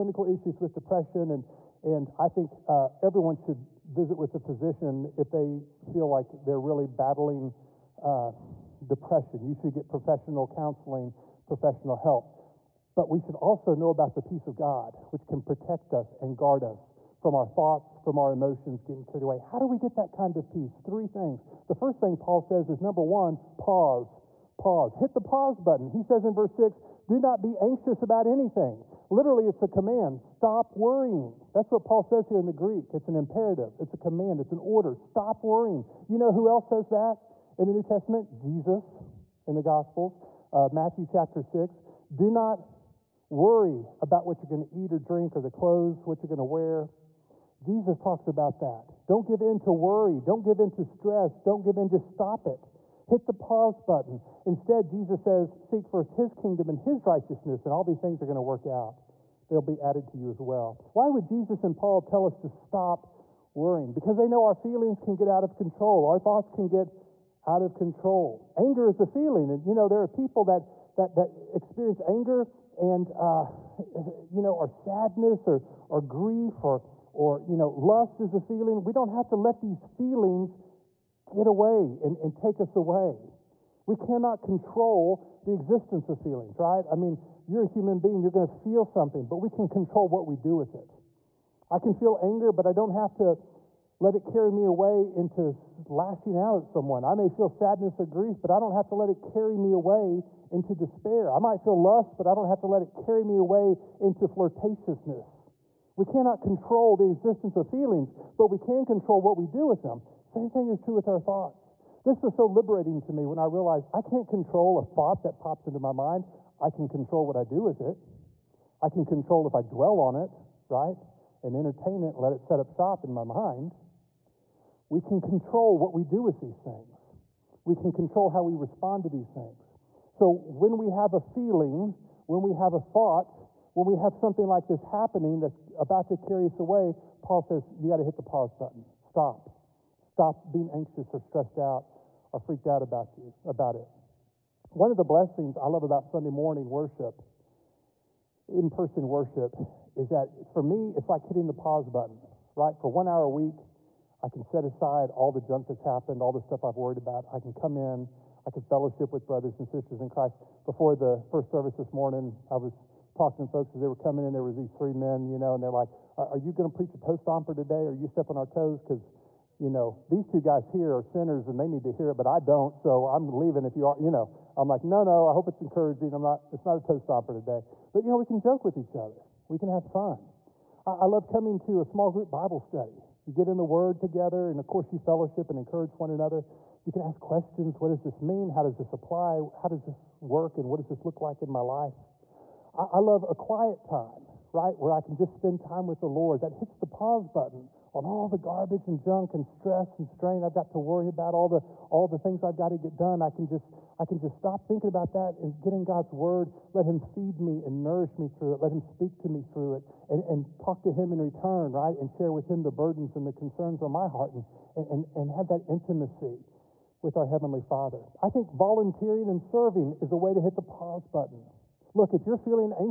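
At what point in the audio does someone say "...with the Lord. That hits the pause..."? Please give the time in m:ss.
3:15.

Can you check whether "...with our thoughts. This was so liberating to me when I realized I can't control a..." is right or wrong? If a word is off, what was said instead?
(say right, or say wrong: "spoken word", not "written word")
right.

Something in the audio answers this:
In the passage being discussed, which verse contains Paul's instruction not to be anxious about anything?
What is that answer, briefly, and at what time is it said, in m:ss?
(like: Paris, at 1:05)
Verse 6, at 0:26.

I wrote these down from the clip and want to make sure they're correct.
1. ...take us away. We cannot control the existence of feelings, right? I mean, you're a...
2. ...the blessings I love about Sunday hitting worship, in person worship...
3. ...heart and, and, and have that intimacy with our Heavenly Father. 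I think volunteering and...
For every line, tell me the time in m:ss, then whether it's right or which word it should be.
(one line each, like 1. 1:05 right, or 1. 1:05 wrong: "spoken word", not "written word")
1. 1:22 right
2. 2:24 wrong: "morning", not "hitting"
3. 3:34 right.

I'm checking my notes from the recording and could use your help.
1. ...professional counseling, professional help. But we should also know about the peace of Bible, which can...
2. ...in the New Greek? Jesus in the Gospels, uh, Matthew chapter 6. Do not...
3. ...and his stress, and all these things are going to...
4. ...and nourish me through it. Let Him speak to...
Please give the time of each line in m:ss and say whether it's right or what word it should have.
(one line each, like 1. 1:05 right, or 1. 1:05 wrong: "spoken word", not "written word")
1. 0:09 wrong: "God", not "Bible"
2. 0:37 wrong: "Testament", not "Greek"
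3. 0:56 wrong: "righteousness", not "stress"
4. 3:27 right.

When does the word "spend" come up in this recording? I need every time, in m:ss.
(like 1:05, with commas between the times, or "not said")
3:15.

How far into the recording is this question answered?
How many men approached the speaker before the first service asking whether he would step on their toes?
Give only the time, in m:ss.
2:44.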